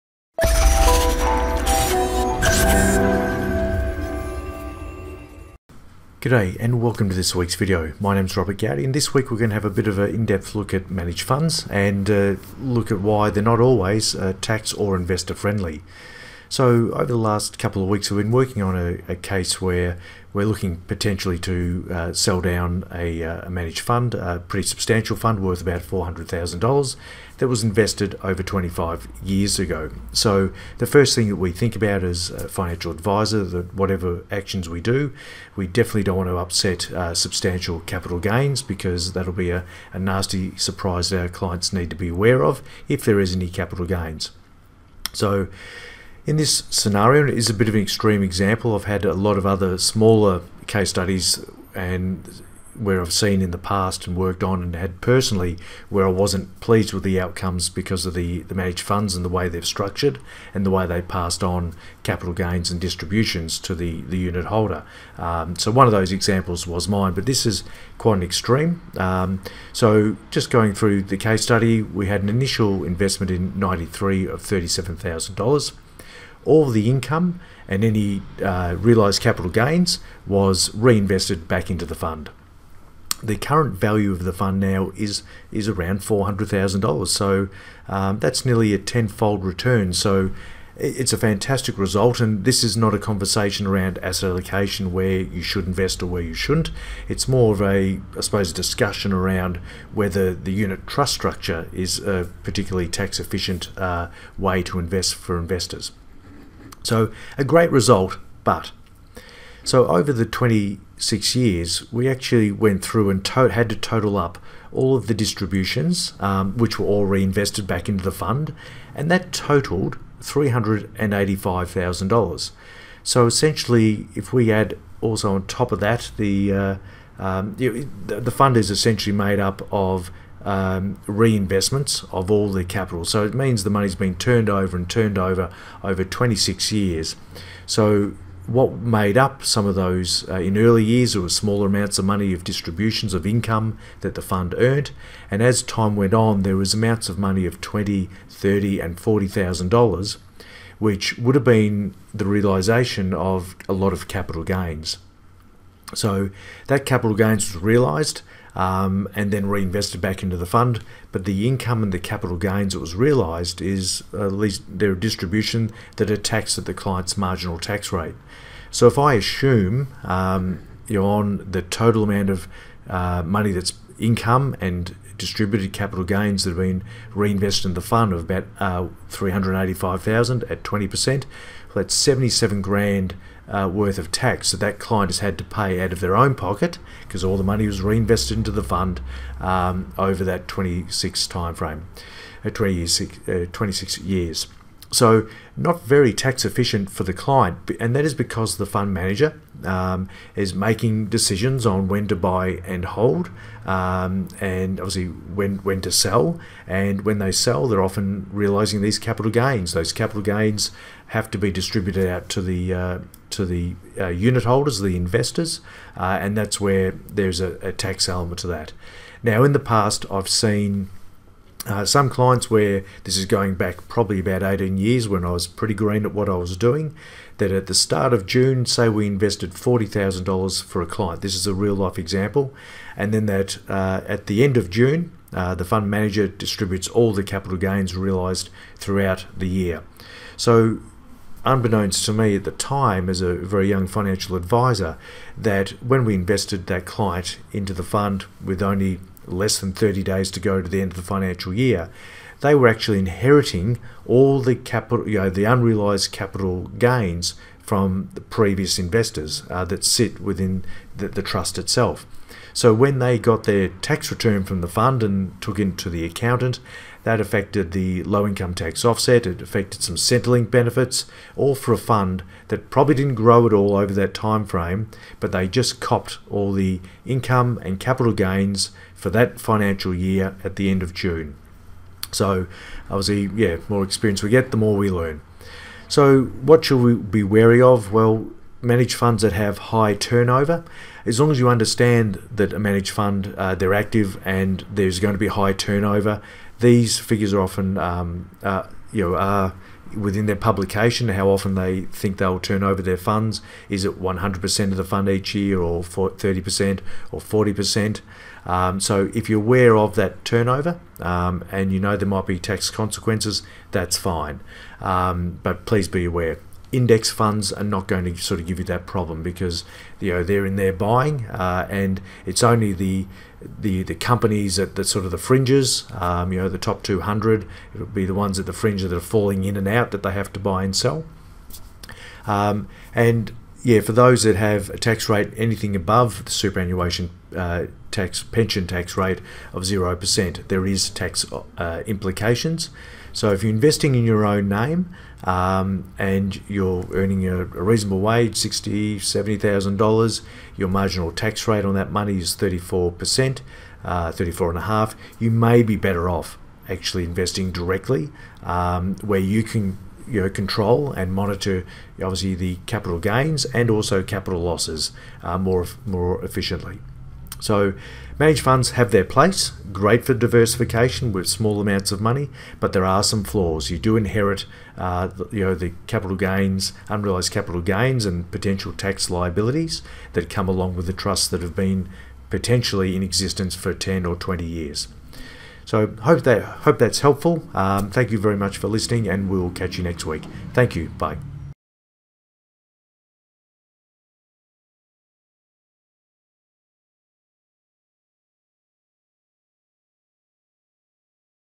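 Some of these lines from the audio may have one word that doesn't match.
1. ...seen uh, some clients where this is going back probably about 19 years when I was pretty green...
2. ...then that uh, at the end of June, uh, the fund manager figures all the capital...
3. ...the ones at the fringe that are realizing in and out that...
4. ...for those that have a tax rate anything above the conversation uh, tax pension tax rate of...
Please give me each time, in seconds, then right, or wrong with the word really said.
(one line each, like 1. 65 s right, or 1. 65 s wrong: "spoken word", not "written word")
1. 220 s wrong: "18", not "19"
2. 233 s wrong: "distributes", not "figures"
3. 328 s wrong: "falling", not "realizing"
4. 333 s wrong: "superannuation", not "conversation".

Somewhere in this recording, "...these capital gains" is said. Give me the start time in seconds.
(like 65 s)
208 s.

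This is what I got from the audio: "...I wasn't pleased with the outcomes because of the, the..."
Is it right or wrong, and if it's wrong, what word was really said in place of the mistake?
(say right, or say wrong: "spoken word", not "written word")
right.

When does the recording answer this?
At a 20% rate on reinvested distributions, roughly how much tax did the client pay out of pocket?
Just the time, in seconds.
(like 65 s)
181 s.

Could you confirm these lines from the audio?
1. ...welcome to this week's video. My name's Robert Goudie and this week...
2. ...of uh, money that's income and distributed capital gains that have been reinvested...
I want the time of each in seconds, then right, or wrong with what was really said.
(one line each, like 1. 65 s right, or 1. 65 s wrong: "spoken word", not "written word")
1. 6 s right
2. 172 s right.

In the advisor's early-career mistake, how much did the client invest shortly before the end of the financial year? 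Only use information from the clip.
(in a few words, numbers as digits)
$40,000.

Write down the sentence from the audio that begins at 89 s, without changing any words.
So it's a fantastic result, and this is not a conversation around asset allocation where you should invest or where you shouldn't.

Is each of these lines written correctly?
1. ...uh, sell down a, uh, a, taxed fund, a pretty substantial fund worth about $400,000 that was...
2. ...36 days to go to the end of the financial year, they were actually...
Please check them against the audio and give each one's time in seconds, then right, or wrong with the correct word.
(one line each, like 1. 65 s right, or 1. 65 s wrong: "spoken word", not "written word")
1. 21 s wrong: "managed", not "taxed"
2. 249 s wrong: "30", not "36".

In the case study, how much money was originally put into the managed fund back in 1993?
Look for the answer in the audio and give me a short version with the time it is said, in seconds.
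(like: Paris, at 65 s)
$37,000, at 74 s.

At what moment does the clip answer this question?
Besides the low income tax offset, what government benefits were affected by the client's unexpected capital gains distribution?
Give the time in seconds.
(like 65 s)
269 s.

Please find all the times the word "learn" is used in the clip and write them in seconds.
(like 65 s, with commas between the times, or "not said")
284 s.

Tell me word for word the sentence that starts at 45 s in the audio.
So in this scenario, it is a bit of an extreme example.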